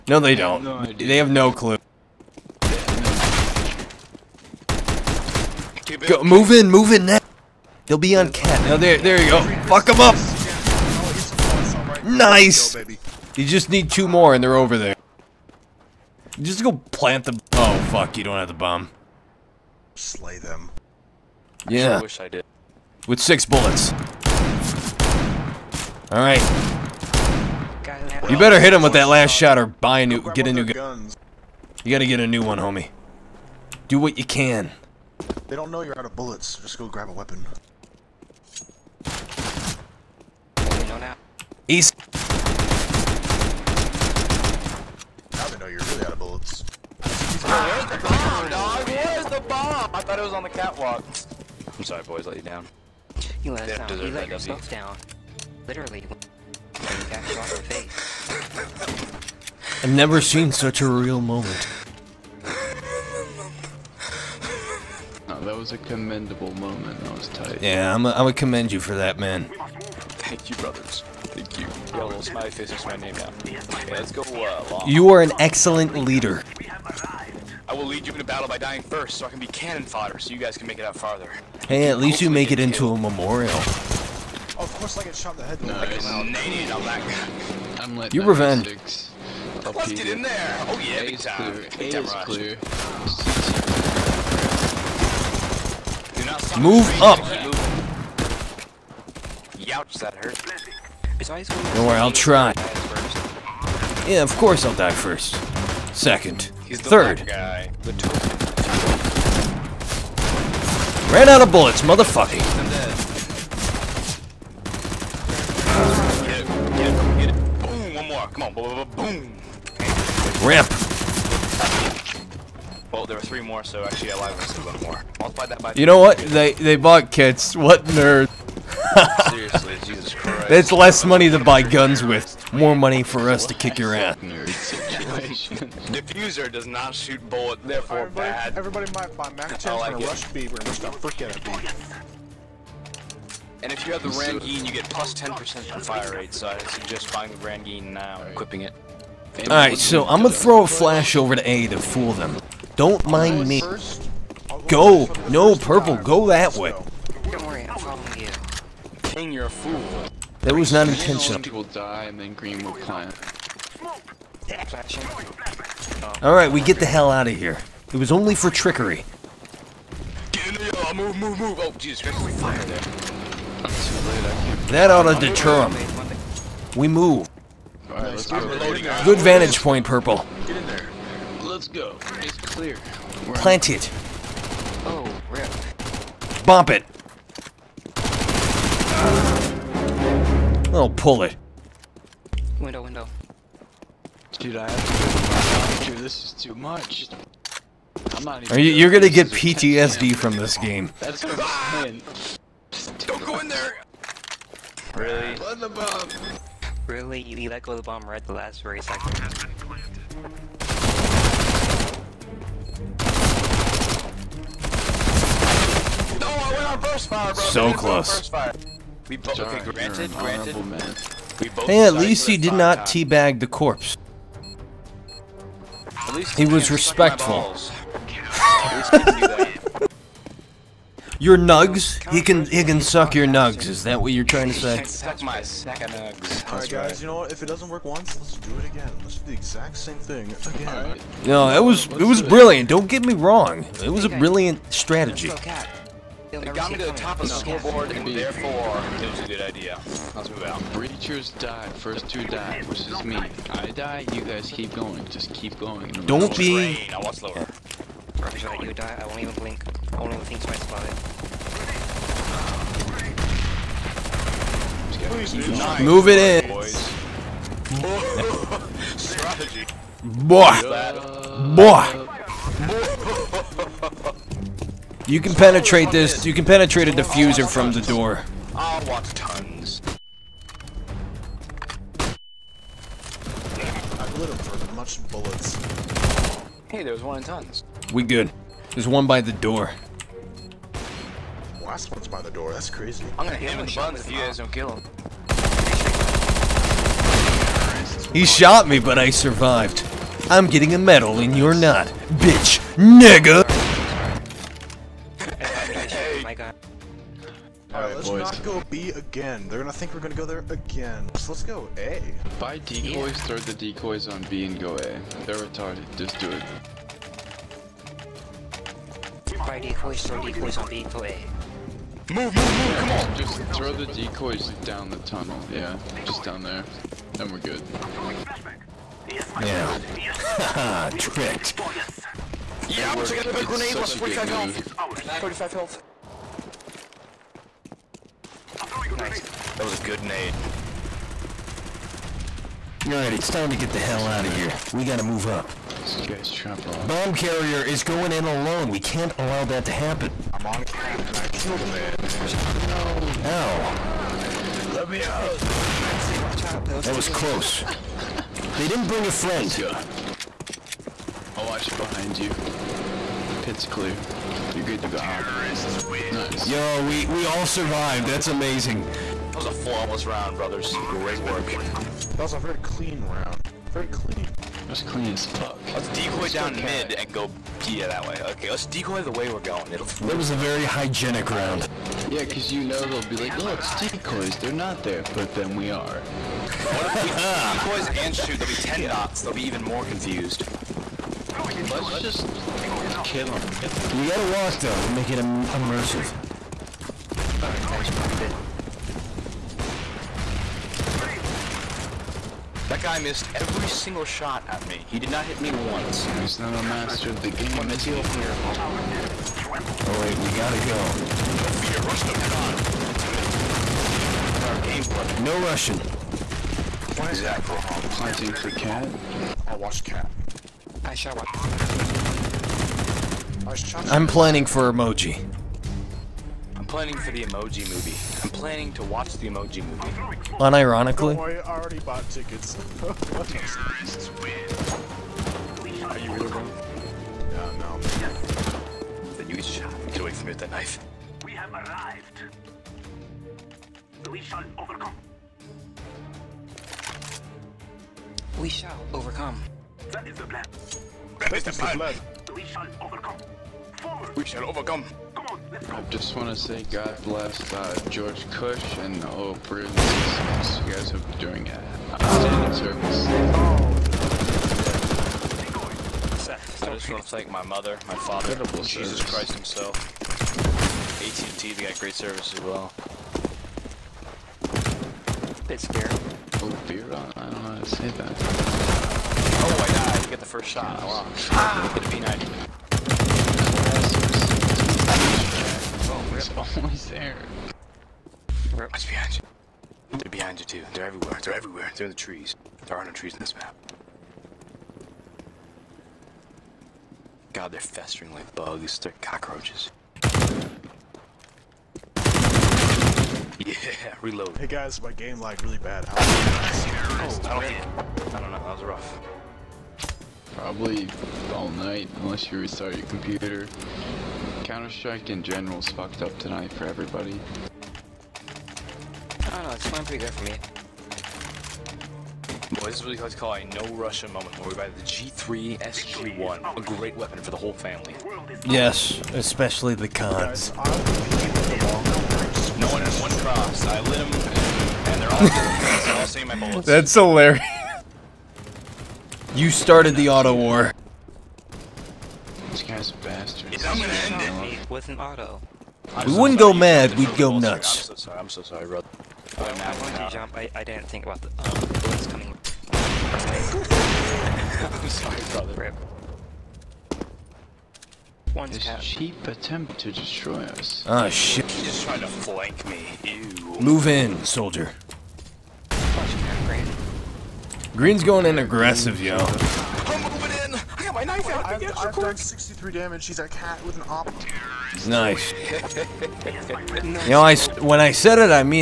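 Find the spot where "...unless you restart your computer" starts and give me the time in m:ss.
8:32.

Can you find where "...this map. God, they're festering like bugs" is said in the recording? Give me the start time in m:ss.
8:13.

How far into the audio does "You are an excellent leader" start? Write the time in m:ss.
1:14.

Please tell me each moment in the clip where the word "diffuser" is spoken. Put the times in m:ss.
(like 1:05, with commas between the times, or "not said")
2:14, 4:36.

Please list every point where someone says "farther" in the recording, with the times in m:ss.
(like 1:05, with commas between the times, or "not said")
1:20.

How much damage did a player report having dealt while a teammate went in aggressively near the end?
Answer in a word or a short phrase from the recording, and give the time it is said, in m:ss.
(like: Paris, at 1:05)
63, at 9:32.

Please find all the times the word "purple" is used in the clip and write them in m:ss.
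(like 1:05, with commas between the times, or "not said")
2:35, 2:59.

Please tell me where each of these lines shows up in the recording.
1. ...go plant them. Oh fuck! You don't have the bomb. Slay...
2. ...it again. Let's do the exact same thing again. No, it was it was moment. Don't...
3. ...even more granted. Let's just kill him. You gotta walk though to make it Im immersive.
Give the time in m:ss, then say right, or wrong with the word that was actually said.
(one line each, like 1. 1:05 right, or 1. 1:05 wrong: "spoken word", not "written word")
1. 0:16 right
2. 3:58 wrong: "brilliant", not "moment"
3. 6:29 wrong: "confused", not "granted".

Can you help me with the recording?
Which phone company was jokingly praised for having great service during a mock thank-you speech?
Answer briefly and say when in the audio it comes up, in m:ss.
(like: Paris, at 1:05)
AT&T, at 7:51.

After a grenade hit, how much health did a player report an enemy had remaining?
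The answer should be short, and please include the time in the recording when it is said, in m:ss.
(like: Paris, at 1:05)
35, at 5:35.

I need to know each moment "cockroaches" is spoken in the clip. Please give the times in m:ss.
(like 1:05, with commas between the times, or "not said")
8:19.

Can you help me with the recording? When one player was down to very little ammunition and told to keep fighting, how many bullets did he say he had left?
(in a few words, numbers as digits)
6.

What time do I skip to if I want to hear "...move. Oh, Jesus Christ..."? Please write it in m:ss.
2:51.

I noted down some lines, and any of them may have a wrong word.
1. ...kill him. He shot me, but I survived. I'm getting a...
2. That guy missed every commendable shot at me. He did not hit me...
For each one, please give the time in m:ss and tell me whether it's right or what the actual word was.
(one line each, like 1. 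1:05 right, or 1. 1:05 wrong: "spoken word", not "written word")
1. 4:54 right
2. 6:42 wrong: "single", not "commendable".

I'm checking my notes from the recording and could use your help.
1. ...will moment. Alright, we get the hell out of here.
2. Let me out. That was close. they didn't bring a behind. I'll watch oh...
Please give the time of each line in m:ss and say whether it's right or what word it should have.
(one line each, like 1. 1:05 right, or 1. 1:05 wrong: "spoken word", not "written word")
1. 2:42 wrong: "plant", not "moment"
2. 5:54 wrong: "friend", not "behind".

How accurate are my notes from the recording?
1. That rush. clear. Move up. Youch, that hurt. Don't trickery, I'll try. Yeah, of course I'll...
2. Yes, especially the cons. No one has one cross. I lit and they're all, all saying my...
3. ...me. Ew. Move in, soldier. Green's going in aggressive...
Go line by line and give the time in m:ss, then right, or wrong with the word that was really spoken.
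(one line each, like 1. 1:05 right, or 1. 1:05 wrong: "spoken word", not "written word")
1. 1:31 wrong: "worry", not "trickery"
2. 8:48 right
3. 9:22 right.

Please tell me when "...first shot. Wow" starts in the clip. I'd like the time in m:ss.
8:00.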